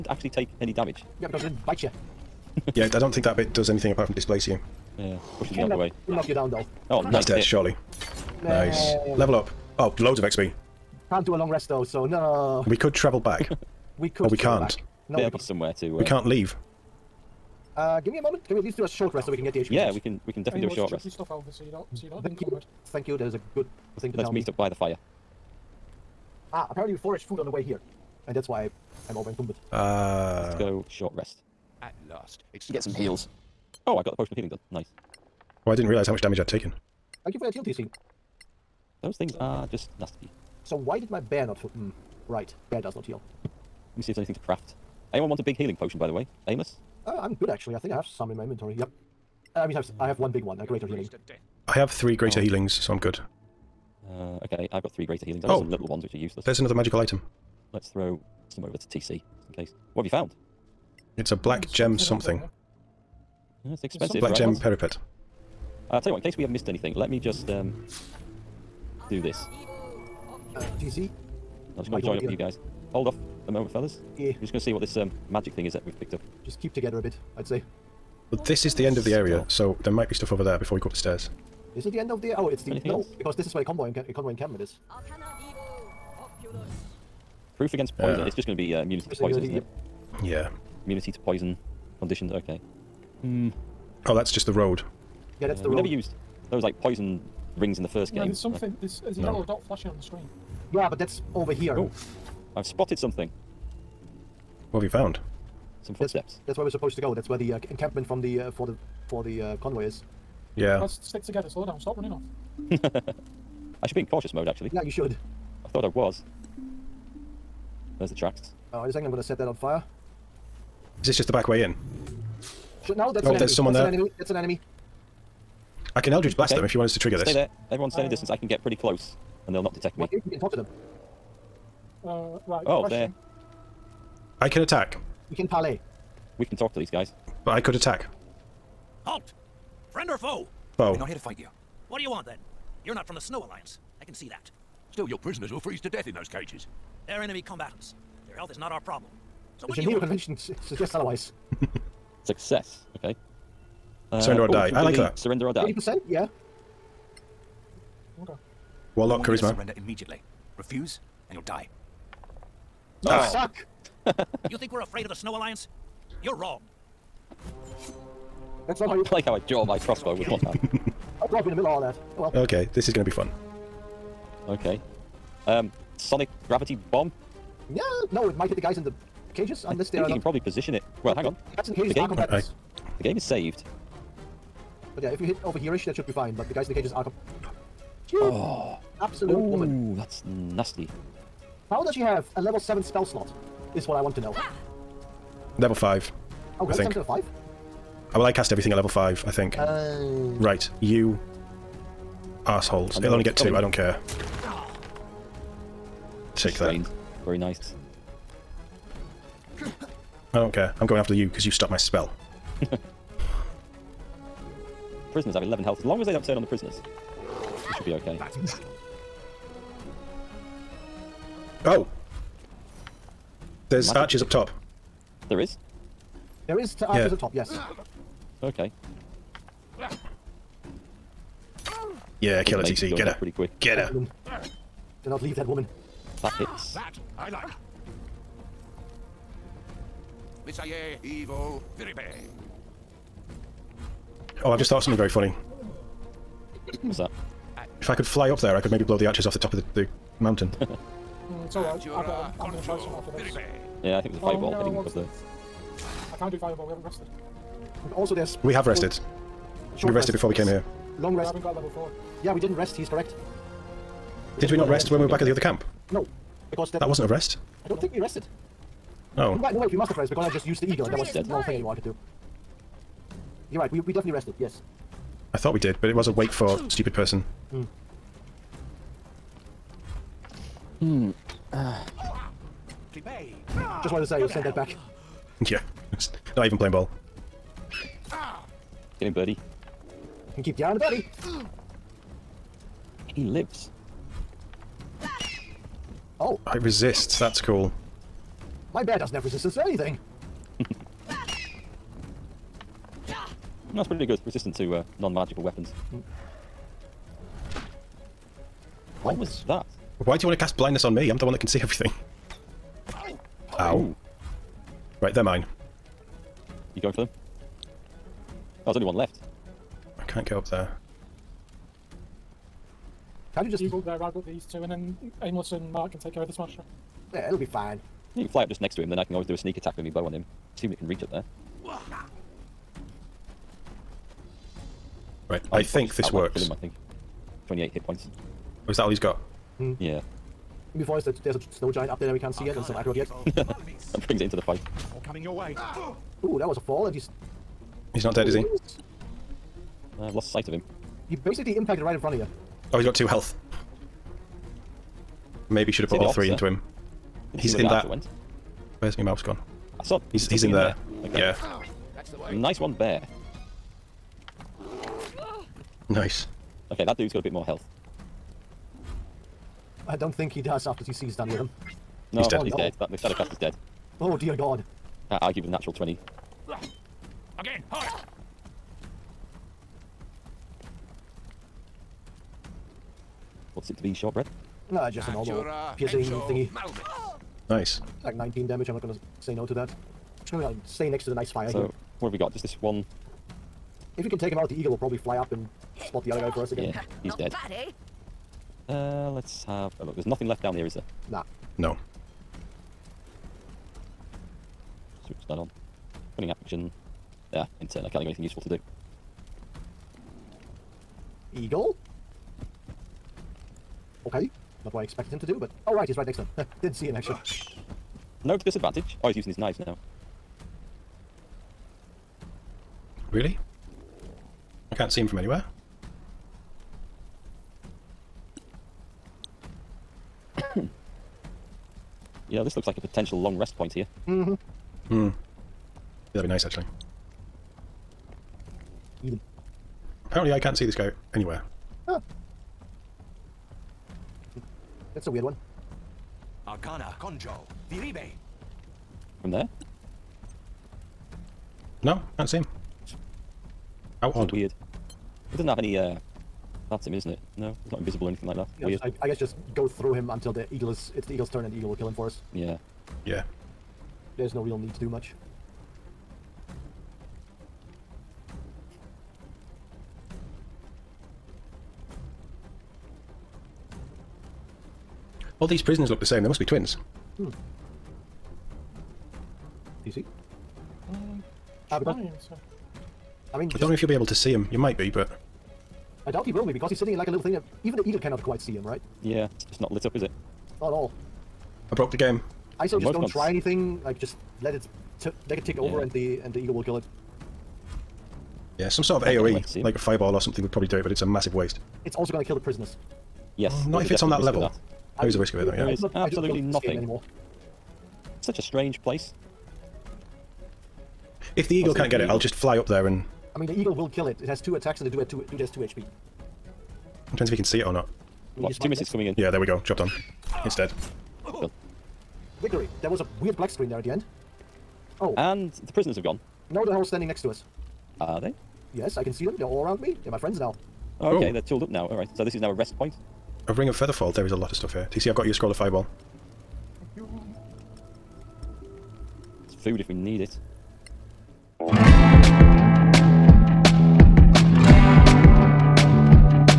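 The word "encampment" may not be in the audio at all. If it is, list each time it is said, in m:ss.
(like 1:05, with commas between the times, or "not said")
1:24, 1:47.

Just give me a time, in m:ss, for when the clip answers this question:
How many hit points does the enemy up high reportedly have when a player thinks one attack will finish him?
5:37.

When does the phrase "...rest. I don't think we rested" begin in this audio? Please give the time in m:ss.
4:27.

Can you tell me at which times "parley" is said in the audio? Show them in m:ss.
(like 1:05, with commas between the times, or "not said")
2:15.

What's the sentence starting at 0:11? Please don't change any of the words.
Can't do a long rest though, so no.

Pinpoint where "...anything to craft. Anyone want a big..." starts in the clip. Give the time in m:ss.
0:44.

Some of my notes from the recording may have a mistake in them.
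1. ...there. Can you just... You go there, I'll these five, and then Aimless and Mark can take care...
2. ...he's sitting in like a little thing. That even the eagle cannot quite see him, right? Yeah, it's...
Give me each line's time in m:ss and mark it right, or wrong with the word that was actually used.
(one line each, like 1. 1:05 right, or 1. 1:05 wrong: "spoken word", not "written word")
1. 5:20 wrong: "two", not "five"
2. 8:06 right.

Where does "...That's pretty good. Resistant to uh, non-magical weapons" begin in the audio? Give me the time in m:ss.
5:03.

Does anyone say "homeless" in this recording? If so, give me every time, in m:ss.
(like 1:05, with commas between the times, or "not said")
not said.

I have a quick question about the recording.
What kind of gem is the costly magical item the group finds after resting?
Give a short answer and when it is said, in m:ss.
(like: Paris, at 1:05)
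Black gem, at 1:01.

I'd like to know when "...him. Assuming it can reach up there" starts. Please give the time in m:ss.
5:30.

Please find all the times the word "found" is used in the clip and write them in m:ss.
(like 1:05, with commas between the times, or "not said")
1:00, 1:44.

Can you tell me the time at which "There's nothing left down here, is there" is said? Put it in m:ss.
6:39.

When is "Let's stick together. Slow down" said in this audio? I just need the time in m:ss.
1:50.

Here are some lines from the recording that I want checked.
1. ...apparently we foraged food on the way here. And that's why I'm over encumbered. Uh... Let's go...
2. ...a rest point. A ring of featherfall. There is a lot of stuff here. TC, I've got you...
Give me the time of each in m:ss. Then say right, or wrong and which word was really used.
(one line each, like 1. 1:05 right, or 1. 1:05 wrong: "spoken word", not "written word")
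1. 0:26 right
2. 8:52 right.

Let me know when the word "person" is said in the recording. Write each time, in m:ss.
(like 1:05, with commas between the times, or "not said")
4:36.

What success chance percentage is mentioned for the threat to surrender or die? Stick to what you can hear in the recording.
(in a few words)
80%.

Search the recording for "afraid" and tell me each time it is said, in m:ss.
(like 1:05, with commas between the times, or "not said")
2:44.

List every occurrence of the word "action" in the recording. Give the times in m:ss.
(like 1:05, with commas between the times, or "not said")
6:46.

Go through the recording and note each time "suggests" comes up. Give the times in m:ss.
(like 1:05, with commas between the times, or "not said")
2:30.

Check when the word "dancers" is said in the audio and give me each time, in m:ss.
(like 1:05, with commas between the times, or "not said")
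not said.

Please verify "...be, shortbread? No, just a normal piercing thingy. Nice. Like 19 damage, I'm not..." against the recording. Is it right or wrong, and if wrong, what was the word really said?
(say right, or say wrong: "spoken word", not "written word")
right.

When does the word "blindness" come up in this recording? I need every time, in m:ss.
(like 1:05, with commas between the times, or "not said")
5:10.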